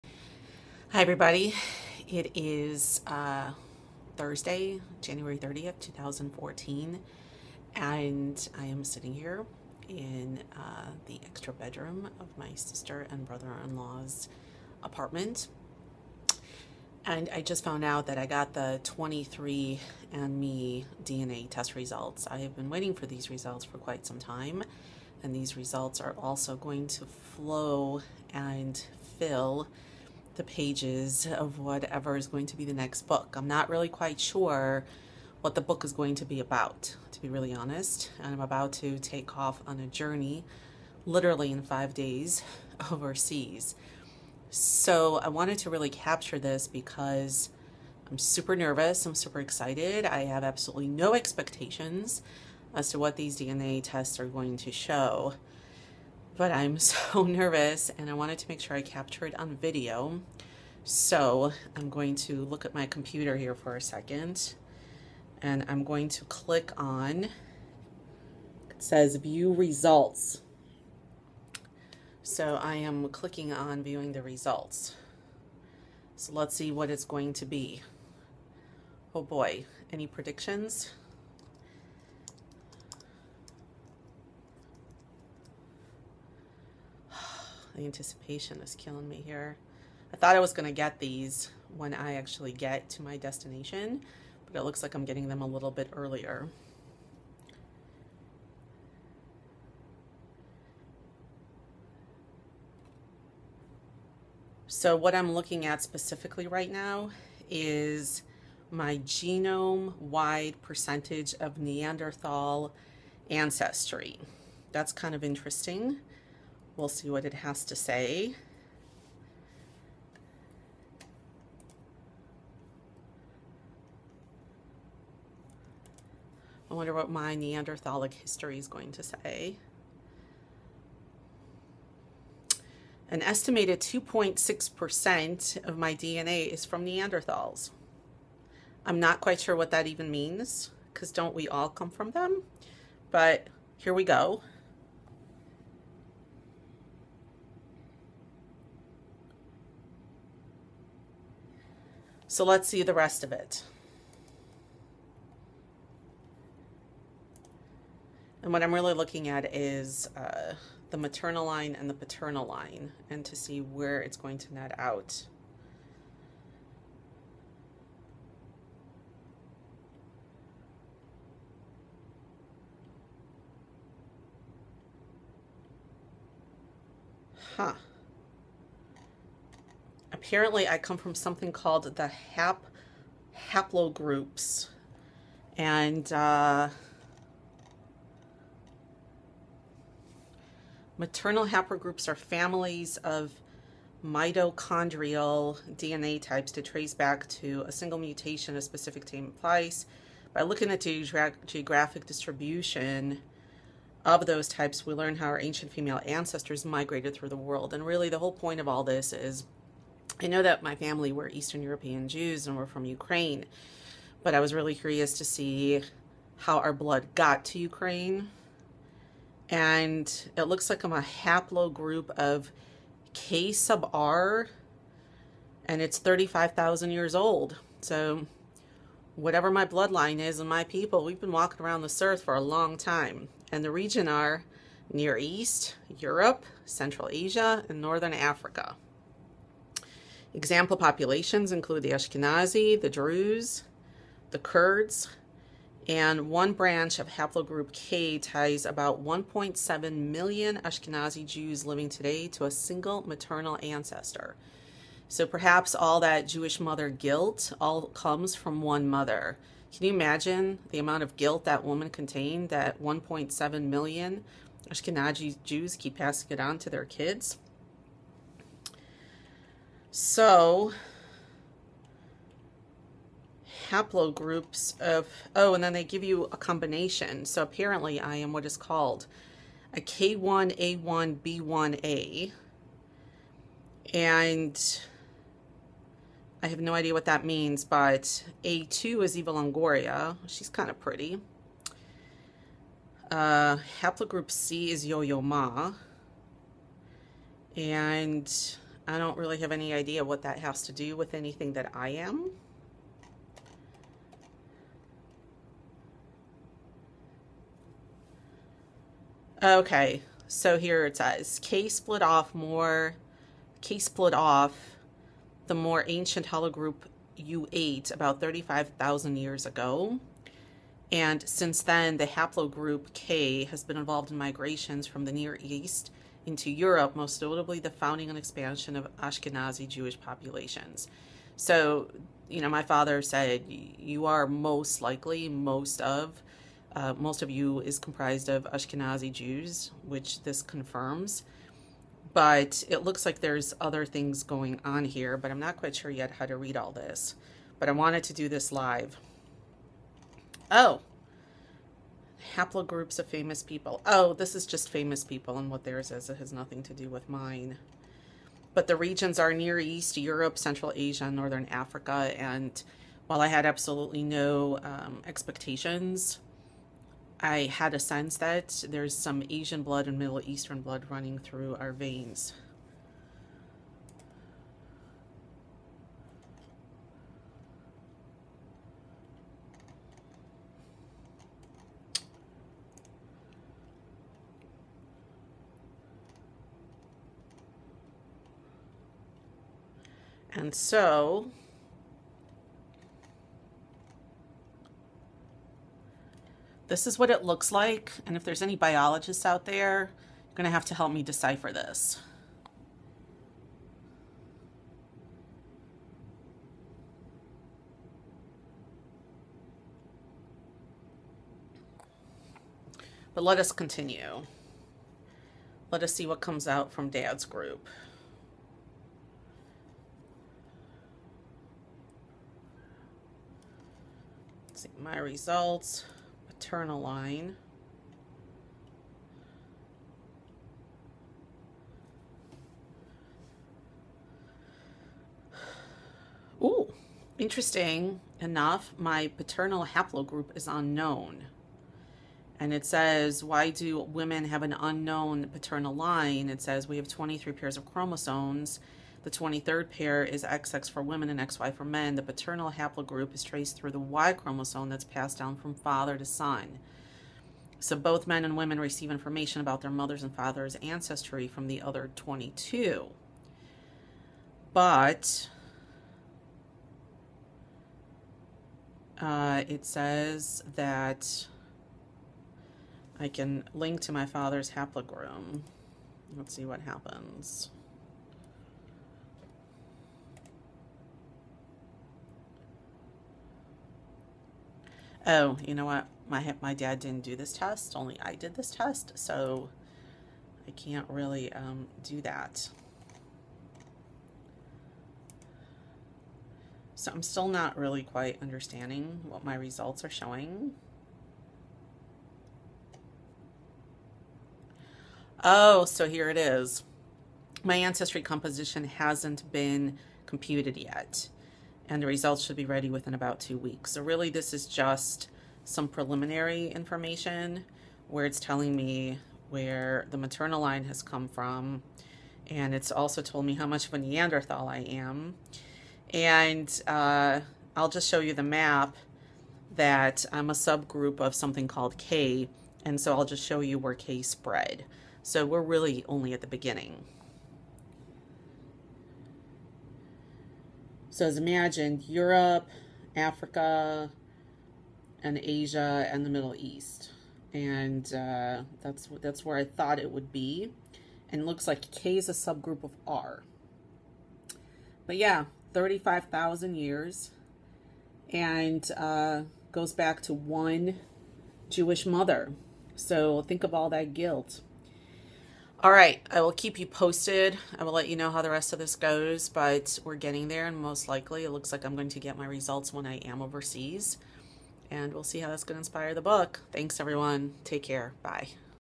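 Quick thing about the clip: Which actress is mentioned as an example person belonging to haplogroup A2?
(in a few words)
Eva Longoria.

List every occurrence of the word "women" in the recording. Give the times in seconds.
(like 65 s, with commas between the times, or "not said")
443 s, 450 s, 458 s.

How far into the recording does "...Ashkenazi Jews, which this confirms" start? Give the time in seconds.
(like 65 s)
338 s.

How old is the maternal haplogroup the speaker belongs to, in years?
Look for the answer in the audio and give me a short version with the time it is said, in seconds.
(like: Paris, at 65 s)
35,000 years, at 225 s.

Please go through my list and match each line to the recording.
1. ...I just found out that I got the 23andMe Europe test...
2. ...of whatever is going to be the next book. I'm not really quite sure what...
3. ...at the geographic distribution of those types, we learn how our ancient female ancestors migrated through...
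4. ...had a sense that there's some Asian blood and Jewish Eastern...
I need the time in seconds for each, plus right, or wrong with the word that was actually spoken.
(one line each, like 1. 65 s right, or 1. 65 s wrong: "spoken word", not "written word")
1. 17 s wrong: "DNA", not "Europe"
2. 31 s right
3. 200 s right
4. 367 s wrong: "Middle", not "Jewish".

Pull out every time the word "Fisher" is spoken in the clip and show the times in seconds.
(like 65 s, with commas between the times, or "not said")
not said.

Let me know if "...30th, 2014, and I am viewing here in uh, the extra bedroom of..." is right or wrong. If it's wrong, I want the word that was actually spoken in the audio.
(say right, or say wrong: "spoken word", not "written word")
wrong: "sitting", not "viewing".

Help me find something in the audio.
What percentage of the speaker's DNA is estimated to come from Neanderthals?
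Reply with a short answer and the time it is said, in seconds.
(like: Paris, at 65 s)
2.6%, at 133 s.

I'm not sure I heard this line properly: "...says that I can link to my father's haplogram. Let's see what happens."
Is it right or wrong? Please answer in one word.
right.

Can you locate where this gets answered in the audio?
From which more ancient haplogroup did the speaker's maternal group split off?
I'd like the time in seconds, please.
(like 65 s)
317 s.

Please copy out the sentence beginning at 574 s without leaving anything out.
And we'll see how that's going to inspire the book.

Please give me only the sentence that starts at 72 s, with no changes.
So I am clicking on viewing the results.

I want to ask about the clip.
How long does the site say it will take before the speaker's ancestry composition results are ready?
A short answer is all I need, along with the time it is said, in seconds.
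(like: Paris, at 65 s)
About two weeks, at 512 s.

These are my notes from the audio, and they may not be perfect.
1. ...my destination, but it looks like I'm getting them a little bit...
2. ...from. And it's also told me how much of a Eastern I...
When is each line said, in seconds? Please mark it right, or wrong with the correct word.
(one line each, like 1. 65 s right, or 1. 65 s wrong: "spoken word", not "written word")
1. 93 s right
2. 521 s wrong: "Neanderthal", not "Eastern".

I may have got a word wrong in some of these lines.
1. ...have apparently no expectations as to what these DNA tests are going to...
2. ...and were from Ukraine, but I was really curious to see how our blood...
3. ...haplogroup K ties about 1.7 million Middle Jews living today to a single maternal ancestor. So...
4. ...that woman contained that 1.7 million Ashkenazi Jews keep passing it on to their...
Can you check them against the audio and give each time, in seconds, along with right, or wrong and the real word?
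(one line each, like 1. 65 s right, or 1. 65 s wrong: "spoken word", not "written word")
1. 50 s wrong: "absolutely", not "apparently"
2. 212 s right
3. 247 s wrong: "Ashkenazi", not "Middle"
4. 261 s right.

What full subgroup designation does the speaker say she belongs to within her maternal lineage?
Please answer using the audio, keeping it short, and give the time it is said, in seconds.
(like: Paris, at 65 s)
K1A1B1A, at 279 s.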